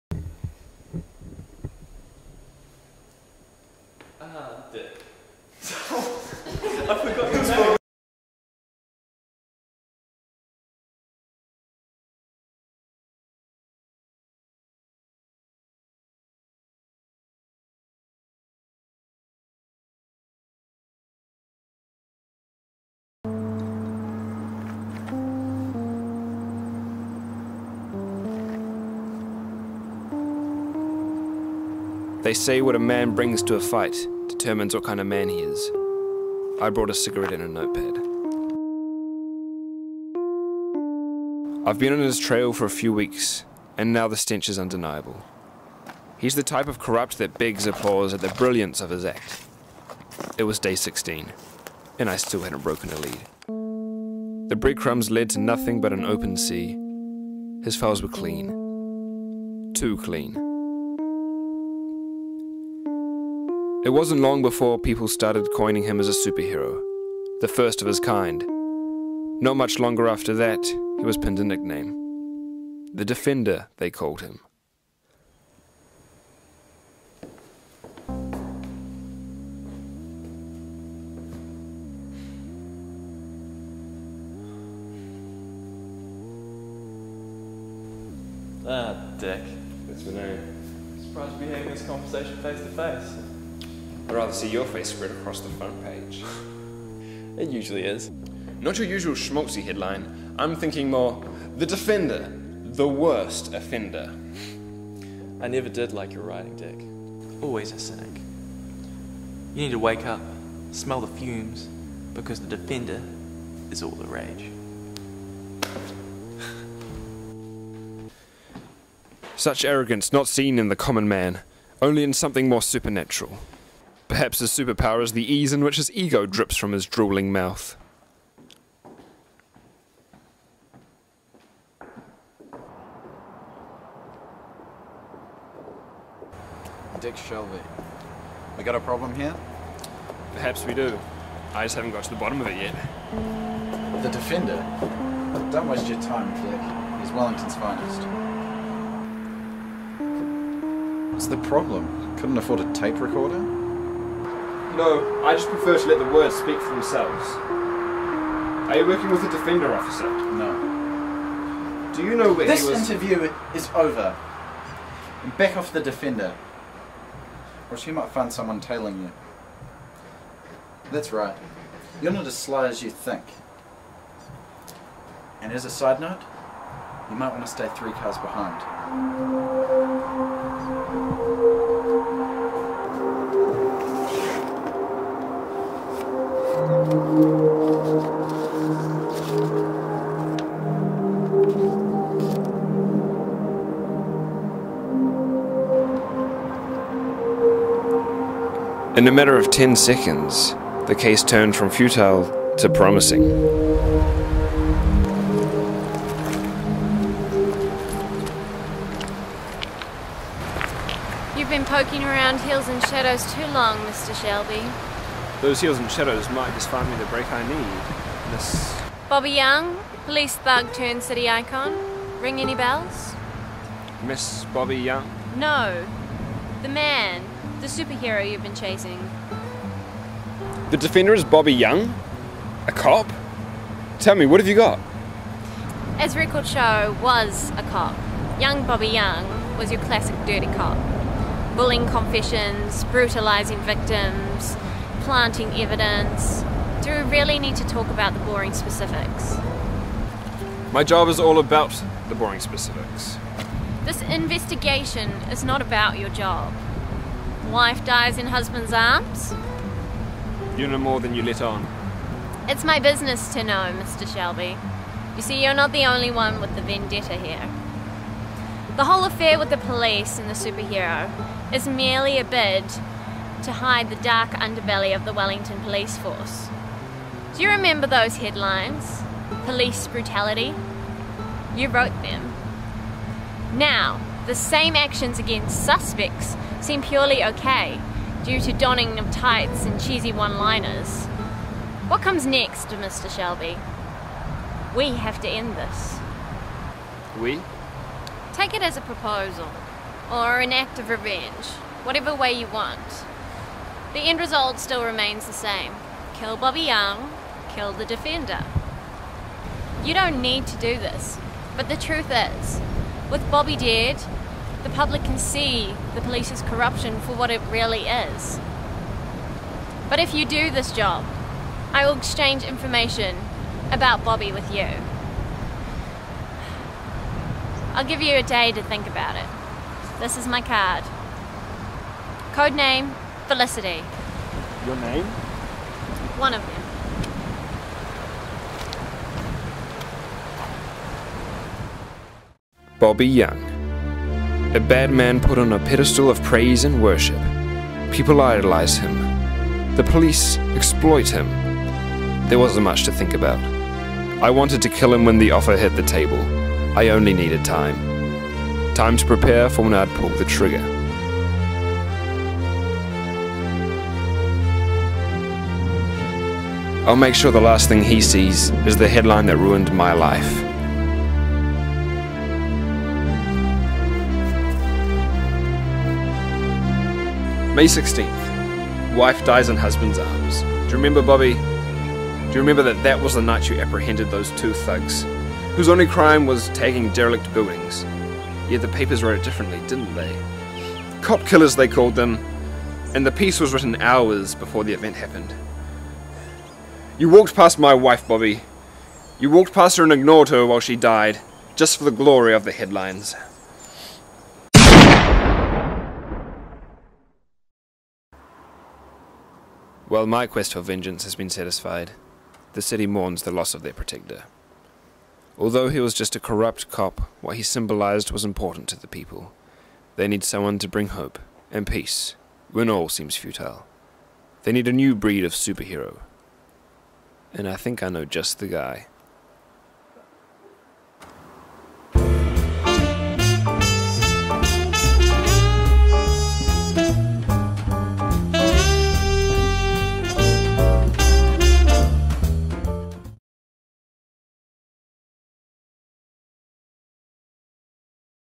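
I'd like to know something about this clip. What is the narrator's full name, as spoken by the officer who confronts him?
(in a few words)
Dick Shelby.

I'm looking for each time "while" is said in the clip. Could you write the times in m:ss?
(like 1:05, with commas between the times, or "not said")
6:40, 6:49.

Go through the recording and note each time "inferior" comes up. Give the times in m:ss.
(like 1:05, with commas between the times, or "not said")
not said.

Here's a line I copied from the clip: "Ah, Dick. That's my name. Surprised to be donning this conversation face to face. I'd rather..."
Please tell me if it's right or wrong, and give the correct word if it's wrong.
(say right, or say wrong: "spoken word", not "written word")
wrong: "having", not "donning".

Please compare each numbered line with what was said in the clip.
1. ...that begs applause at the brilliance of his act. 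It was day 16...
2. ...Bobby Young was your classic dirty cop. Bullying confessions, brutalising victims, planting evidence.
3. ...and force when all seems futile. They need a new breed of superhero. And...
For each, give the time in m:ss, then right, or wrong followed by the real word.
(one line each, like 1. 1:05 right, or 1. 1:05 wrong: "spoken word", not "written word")
1. 0:47 right
2. 3:58 right
3. 7:01 wrong: "peace", not "force".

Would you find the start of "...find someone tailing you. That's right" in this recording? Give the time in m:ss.
2:48.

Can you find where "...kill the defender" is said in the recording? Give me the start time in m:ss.
5:07.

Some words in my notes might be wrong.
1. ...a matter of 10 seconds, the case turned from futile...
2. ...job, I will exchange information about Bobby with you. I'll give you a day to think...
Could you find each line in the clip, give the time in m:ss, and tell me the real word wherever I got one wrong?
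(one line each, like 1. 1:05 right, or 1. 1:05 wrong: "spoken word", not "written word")
1. 3:19 right
2. 5:20 right.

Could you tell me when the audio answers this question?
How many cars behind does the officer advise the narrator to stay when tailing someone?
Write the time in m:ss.
2:57.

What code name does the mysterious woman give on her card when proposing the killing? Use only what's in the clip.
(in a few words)
Felicity.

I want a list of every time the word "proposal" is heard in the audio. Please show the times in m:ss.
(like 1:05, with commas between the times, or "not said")
4:58.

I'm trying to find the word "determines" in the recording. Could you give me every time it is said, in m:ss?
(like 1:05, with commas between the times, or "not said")
0:34.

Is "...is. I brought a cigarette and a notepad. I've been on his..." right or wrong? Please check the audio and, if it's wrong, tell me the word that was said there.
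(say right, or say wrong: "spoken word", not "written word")
right.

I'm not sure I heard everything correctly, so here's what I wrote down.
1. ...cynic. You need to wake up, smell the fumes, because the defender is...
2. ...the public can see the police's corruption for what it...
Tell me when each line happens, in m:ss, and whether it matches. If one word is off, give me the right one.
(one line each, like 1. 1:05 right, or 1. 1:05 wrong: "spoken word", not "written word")
1. 1:47 right
2. 5:14 right.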